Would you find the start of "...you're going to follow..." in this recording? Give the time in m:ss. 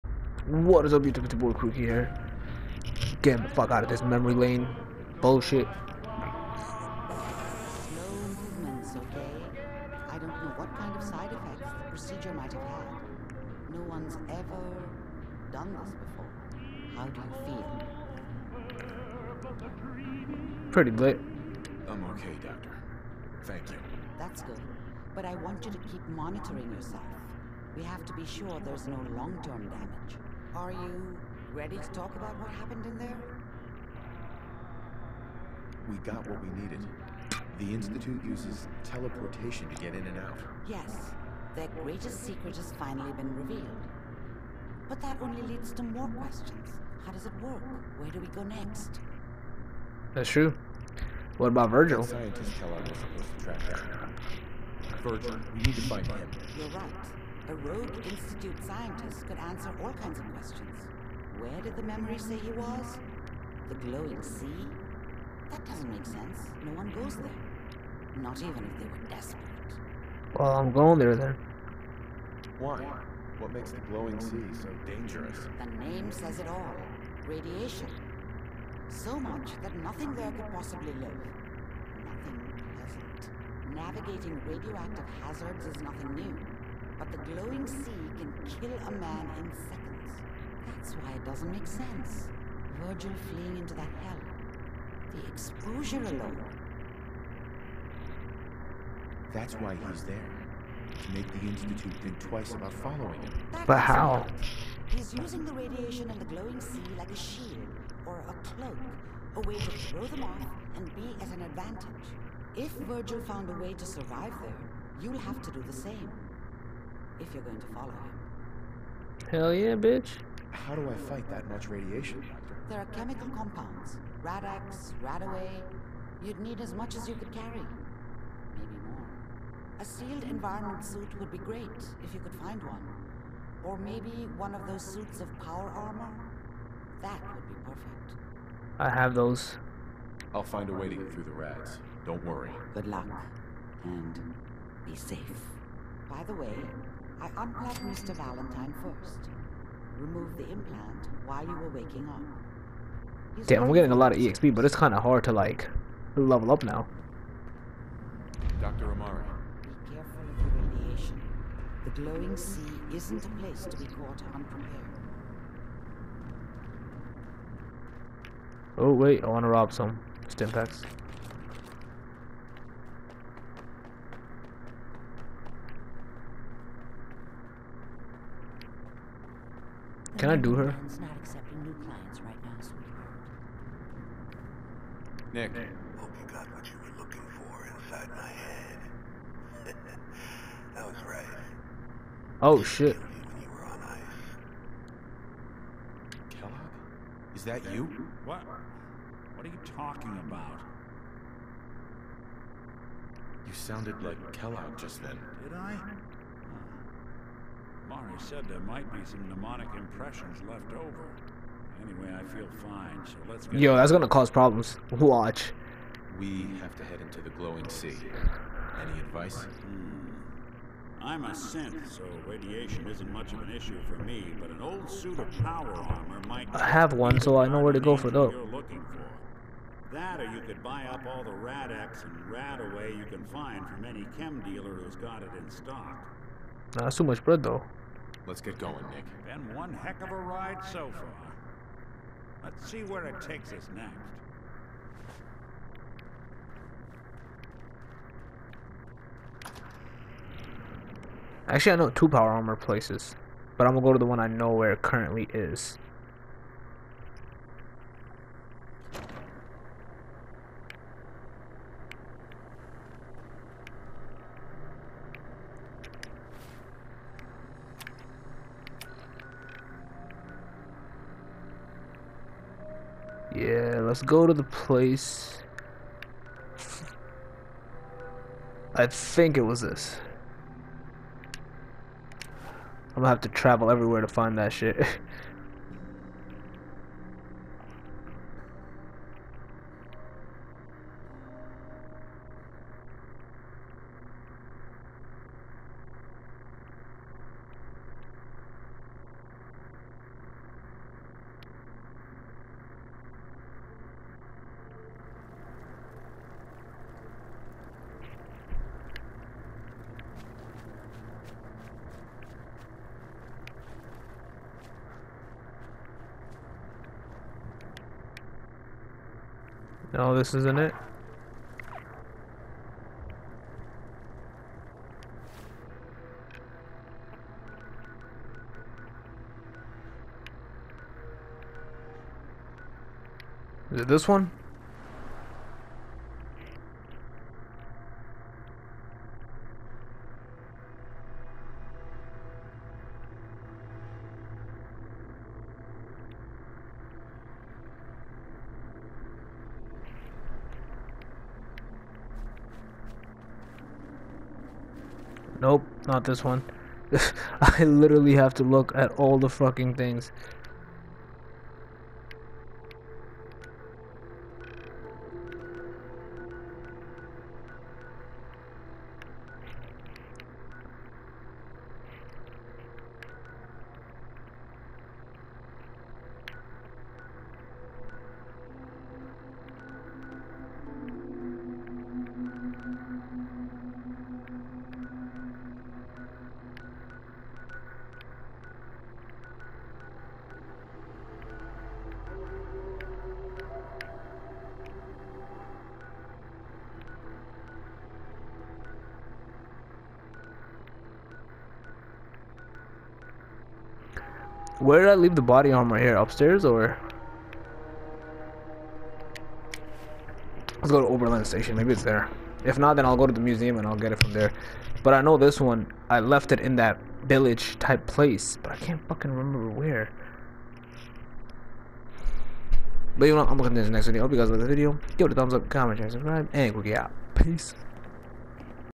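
1:57.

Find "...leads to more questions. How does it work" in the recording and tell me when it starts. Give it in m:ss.
0:45.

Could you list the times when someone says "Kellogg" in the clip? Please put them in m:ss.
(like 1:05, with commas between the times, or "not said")
3:16, 3:24.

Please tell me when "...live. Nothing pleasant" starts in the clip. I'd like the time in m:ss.
1:20.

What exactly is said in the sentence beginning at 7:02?
But you know, I'm looking at this next video.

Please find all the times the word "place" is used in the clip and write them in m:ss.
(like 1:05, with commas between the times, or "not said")
2:43, 4:12, 4:34, 6:57.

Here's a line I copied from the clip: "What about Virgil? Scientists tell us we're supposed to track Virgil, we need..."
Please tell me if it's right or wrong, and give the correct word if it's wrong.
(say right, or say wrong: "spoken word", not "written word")
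right.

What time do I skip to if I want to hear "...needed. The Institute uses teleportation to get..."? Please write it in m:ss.
0:36.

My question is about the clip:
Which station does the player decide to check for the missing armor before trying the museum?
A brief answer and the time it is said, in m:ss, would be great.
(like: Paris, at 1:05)
Oberland Station, at 6:50.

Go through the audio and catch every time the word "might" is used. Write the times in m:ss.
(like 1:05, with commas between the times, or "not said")
0:12, 3:28, 3:46.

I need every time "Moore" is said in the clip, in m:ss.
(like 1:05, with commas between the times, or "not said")
not said.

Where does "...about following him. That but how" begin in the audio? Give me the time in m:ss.
1:42.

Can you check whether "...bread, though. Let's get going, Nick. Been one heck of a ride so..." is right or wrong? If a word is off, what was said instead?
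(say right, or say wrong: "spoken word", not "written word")
right.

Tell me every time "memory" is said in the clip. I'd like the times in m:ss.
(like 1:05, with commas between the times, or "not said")
0:04, 1:01.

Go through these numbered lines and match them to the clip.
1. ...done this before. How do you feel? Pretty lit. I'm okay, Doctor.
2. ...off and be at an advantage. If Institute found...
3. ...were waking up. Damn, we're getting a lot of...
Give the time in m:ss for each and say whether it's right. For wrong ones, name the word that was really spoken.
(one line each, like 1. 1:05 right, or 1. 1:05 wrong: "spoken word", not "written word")
1. 0:15 right
2. 1:50 wrong: "Virgil", not "Institute"
3. 2:31 right.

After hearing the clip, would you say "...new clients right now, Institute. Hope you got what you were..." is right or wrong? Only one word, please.
wrong.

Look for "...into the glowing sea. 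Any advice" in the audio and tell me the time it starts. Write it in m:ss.
3:37.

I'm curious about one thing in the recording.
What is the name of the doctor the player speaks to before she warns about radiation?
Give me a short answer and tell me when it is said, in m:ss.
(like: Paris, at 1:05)
Dr. Amari, at 2:38.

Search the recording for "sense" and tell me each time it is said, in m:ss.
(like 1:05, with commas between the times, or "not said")
1:06, 1:31.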